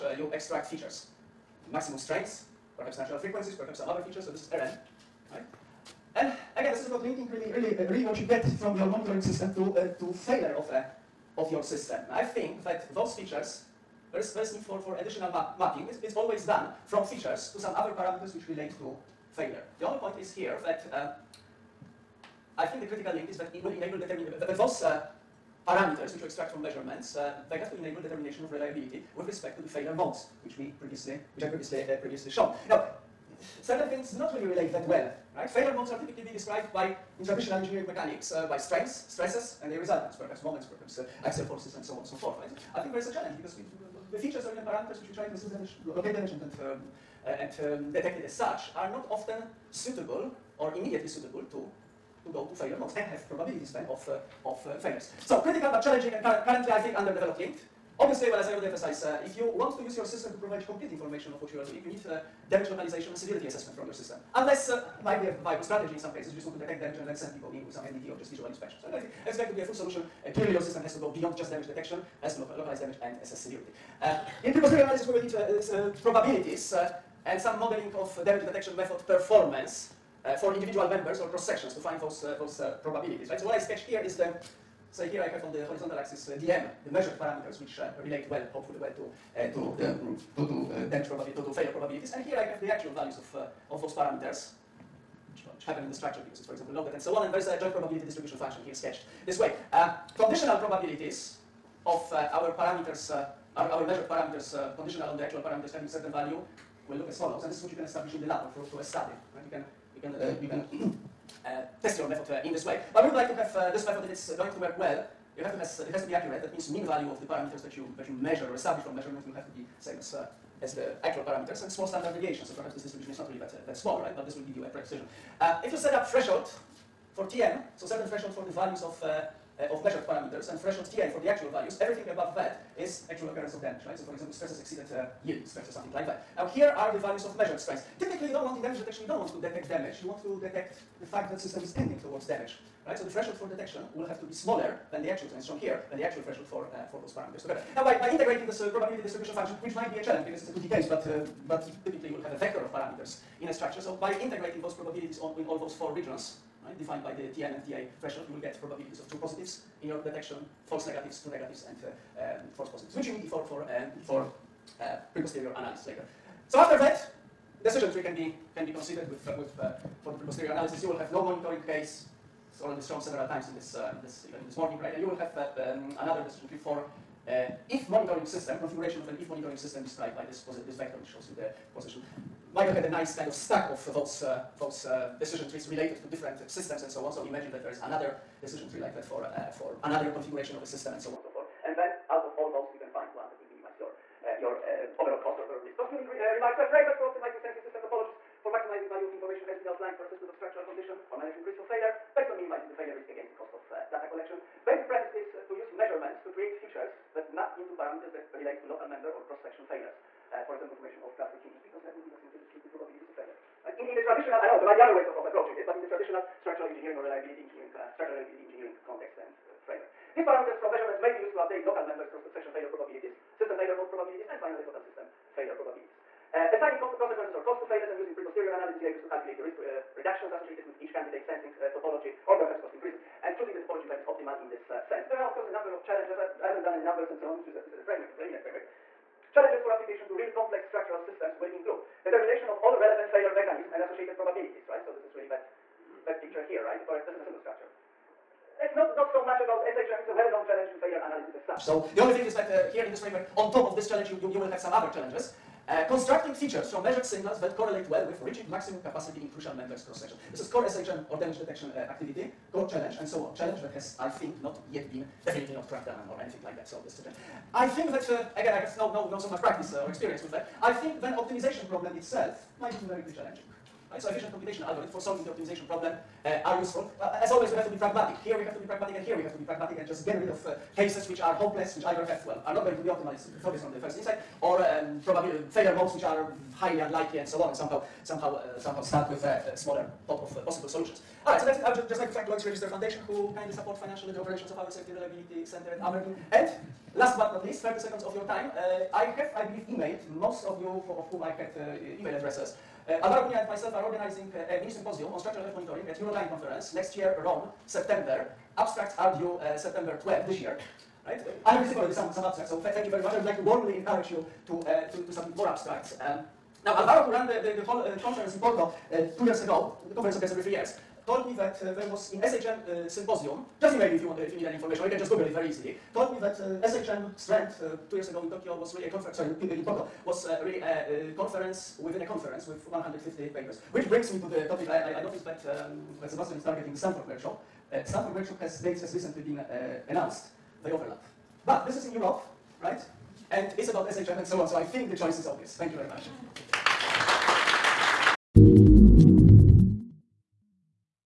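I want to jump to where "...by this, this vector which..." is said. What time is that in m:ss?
3:00.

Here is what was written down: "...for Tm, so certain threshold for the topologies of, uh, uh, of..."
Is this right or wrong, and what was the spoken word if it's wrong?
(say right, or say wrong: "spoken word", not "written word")
wrong: "values", not "topologies".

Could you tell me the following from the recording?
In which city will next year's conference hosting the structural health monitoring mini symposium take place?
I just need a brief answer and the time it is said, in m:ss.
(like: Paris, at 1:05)
Rome, at 5:07.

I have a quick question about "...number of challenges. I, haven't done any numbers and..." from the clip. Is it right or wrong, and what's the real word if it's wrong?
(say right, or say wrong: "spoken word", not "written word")
right.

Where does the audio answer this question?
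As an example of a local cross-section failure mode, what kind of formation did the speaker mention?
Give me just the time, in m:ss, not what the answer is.
3:31.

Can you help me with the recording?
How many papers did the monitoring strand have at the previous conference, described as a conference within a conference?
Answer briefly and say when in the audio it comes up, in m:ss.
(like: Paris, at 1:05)
150, at 5:32.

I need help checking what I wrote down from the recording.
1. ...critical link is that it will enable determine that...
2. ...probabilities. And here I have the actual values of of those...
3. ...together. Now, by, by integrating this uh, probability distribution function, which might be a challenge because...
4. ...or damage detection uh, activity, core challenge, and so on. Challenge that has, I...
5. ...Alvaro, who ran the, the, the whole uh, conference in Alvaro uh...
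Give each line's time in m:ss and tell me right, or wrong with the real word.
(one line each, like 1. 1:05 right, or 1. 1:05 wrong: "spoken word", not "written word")
1. 0:22 right
2. 1:31 right
3. 2:27 right
4. 4:21 right
5. 5:16 wrong: "Porto", not "Alvaro".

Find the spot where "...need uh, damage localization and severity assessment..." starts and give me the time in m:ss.
1:01.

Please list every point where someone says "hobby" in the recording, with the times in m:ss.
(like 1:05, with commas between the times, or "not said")
not said.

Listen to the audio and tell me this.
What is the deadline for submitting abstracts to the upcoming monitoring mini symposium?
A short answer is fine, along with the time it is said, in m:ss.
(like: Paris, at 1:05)
September 12, at 5:09.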